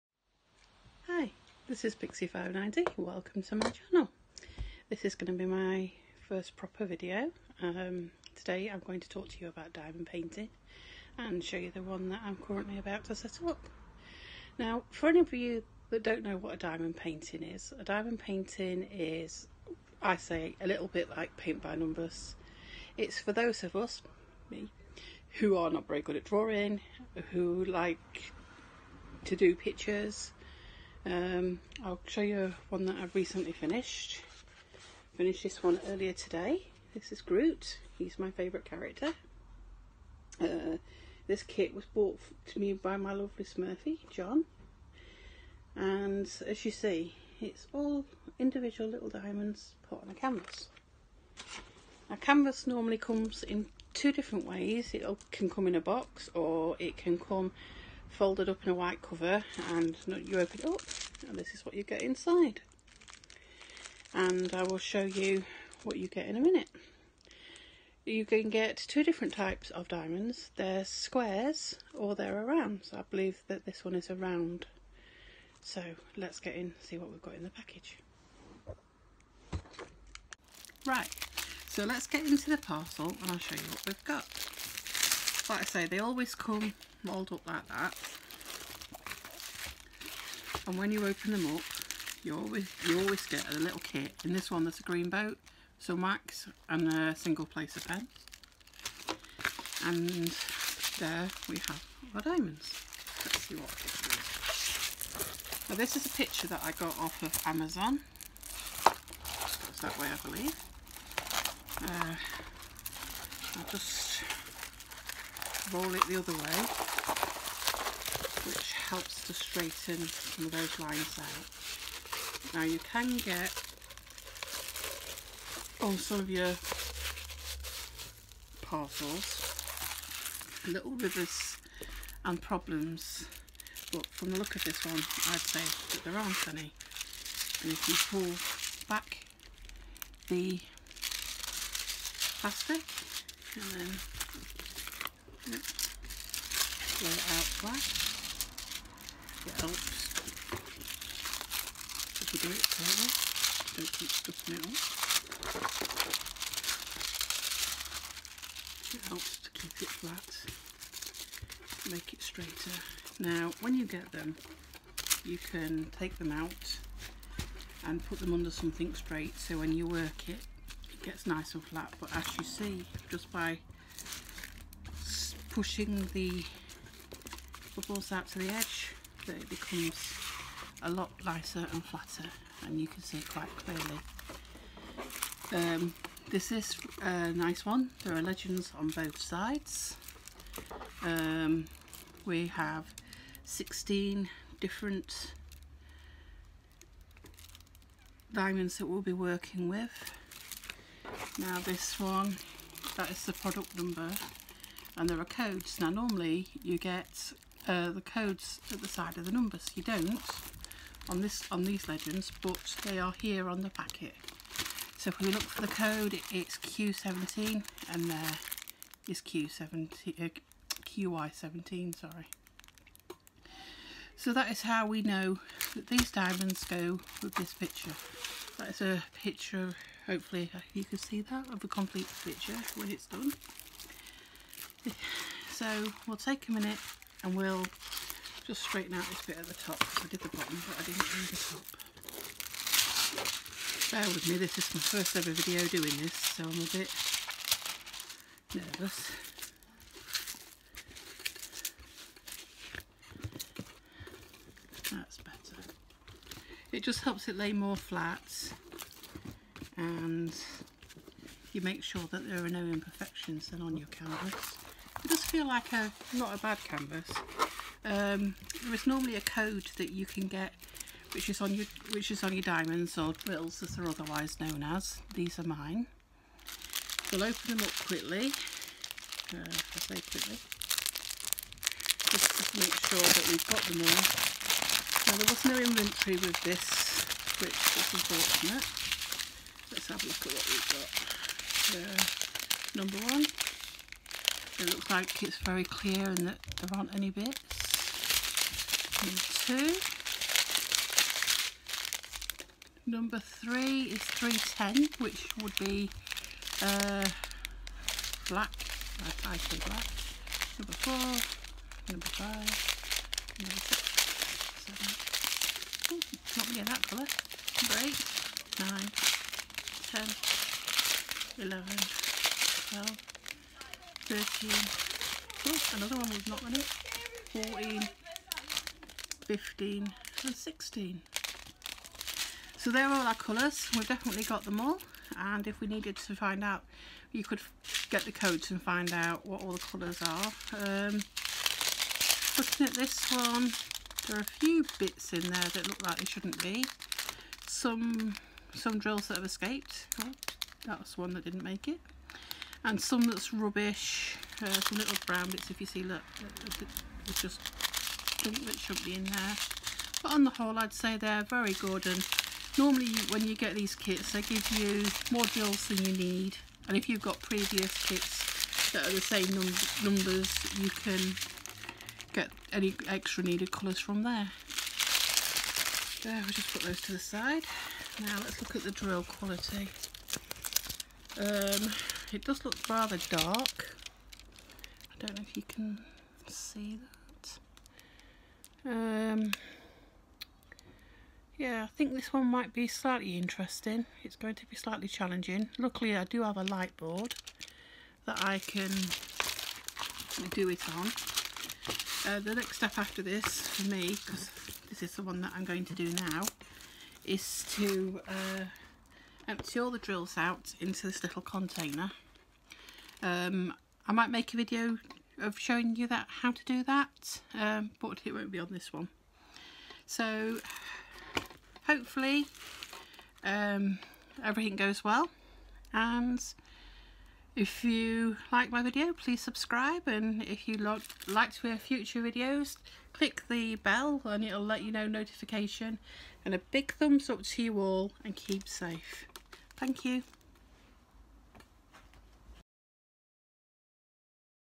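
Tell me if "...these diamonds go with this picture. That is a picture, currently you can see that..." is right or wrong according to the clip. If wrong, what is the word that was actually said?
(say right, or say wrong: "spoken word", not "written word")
wrong: "hopefully", not "currently".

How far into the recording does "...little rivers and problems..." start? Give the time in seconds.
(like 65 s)
130 s.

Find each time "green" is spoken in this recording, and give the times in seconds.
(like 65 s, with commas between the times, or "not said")
94 s.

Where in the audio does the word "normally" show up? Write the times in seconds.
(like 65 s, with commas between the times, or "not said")
52 s, 205 s, 268 s, 362 s.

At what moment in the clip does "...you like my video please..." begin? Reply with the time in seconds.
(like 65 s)
427 s.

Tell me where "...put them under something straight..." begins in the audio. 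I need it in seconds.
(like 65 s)
168 s.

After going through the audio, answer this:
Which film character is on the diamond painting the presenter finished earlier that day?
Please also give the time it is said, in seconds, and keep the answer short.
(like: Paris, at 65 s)
Groot, at 37 s.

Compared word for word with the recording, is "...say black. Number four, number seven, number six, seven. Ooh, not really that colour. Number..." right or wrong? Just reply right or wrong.
wrong.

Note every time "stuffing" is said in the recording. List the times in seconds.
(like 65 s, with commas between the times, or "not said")
154 s.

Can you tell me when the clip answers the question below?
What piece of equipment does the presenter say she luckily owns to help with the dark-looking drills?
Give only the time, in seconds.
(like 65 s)
396 s.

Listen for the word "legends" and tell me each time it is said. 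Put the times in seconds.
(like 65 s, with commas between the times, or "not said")
188 s, 211 s.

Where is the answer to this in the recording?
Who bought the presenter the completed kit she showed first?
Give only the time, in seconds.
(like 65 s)
44 s.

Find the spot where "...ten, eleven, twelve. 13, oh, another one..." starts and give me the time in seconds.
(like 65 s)
321 s.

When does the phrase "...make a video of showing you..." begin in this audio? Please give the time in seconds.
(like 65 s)
414 s.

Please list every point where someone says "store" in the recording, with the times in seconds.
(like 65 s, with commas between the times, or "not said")
not said.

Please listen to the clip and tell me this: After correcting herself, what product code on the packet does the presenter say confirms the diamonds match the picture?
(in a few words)
QI17.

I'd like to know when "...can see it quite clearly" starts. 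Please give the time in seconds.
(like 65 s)
182 s.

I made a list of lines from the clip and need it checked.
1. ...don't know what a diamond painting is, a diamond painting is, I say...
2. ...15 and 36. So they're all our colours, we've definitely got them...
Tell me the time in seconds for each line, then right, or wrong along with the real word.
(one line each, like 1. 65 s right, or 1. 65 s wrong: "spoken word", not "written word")
1. 16 s right
2. 329 s wrong: "16", not "36".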